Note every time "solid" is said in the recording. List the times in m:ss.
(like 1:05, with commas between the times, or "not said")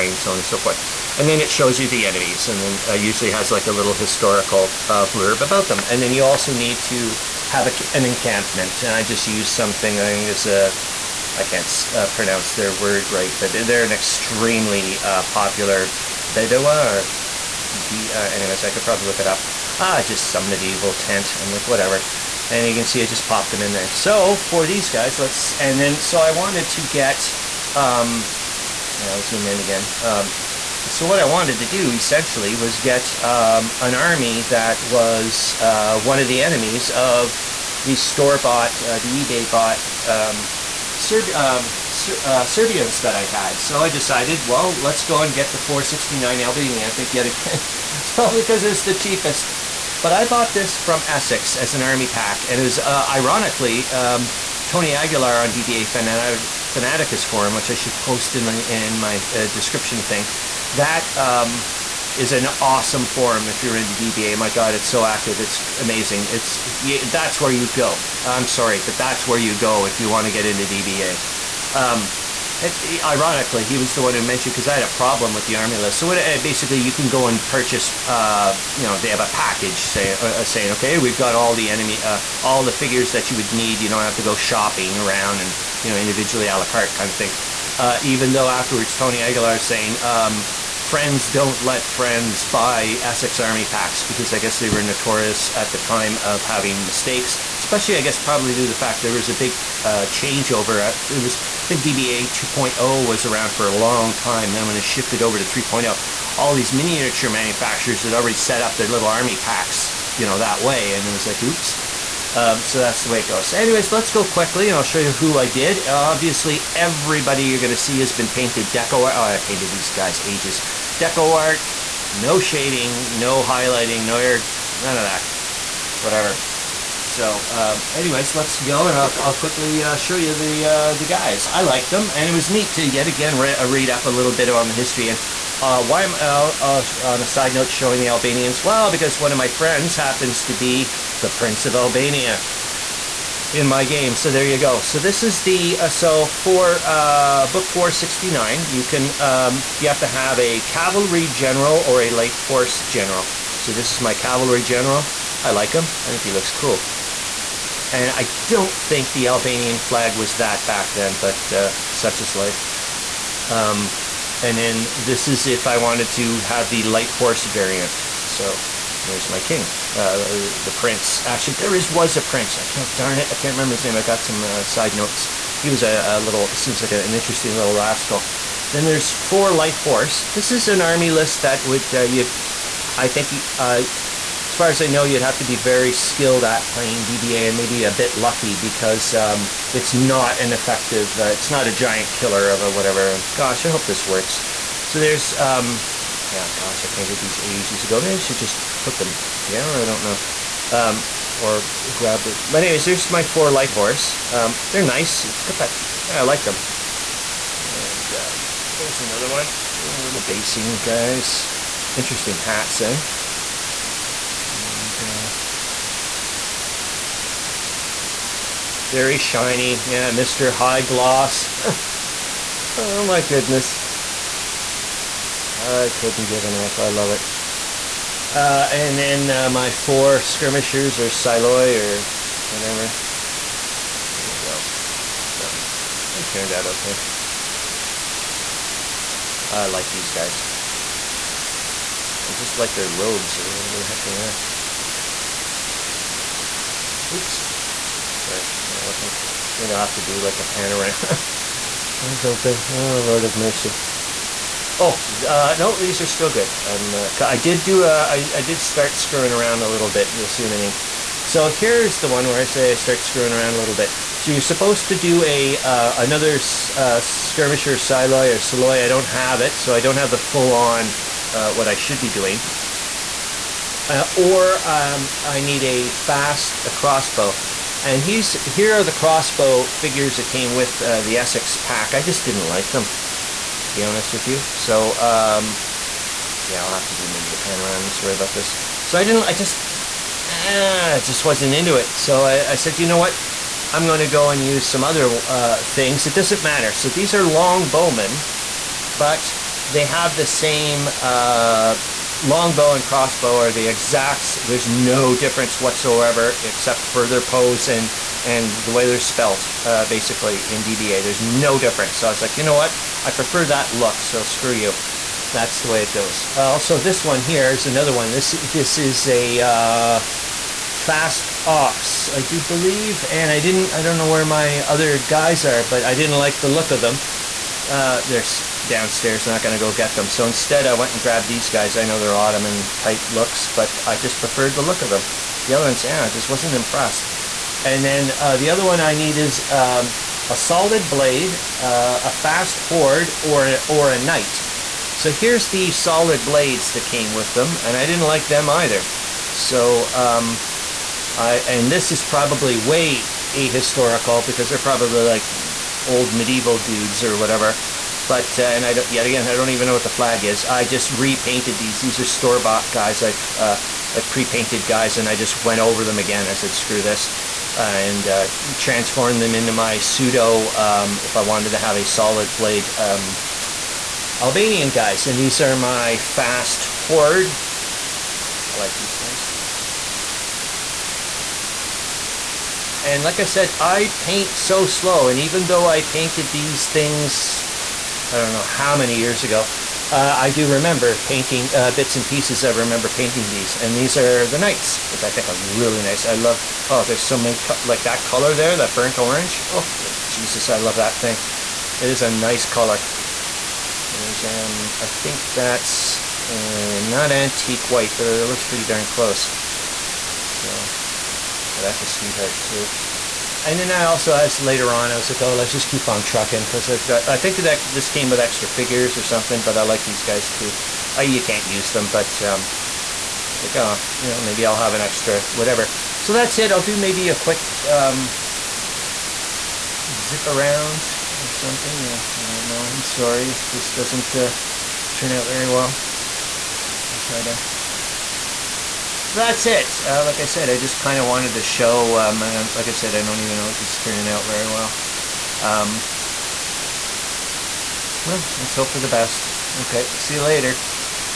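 5:40, 5:45, 6:11.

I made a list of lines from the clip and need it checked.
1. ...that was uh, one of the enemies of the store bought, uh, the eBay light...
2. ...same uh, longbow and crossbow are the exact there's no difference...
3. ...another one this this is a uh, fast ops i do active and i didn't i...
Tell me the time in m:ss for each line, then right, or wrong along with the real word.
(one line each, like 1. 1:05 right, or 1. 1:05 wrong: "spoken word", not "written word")
1. 0:34 wrong: "bought", not "light"
2. 5:00 right
3. 5:17 wrong: "believe", not "active".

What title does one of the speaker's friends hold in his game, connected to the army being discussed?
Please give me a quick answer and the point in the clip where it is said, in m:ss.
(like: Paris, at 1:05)
Prince of Albania, at 2:21.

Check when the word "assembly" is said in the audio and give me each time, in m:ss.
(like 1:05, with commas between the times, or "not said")
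not said.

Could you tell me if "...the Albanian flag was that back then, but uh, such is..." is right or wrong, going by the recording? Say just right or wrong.
right.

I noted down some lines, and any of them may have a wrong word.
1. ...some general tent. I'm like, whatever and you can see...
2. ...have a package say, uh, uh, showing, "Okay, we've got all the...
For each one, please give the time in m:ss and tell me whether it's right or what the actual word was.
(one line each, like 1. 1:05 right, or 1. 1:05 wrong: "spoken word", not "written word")
1. 0:20 wrong: "medieval", not "general"
2. 1:19 wrong: "saying", not "showing".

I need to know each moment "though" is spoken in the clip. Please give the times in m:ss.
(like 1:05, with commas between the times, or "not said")
1:28, 6:25.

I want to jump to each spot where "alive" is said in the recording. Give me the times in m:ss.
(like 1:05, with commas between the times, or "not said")
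not said.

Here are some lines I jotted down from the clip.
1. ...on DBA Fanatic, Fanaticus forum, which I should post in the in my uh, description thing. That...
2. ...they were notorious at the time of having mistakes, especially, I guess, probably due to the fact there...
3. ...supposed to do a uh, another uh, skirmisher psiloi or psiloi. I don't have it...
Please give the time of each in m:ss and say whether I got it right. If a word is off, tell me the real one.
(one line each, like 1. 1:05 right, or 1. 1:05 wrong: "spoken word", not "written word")
1. 0:55 right
2. 1:34 right
3. 4:24 right.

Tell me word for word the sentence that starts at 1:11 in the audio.
Um, it, ironically, he was the one who mentioned because I had a problem with the army list.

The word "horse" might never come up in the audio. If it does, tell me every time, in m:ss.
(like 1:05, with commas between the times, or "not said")
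2:32, 2:47, 2:59, 3:23.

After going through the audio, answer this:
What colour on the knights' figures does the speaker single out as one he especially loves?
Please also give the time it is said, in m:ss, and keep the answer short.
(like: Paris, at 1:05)
Burnt orange, at 6:38.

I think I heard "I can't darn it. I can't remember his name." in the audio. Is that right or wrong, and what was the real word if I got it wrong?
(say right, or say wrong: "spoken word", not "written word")
right.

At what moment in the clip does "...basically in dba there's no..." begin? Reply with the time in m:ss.
5:09.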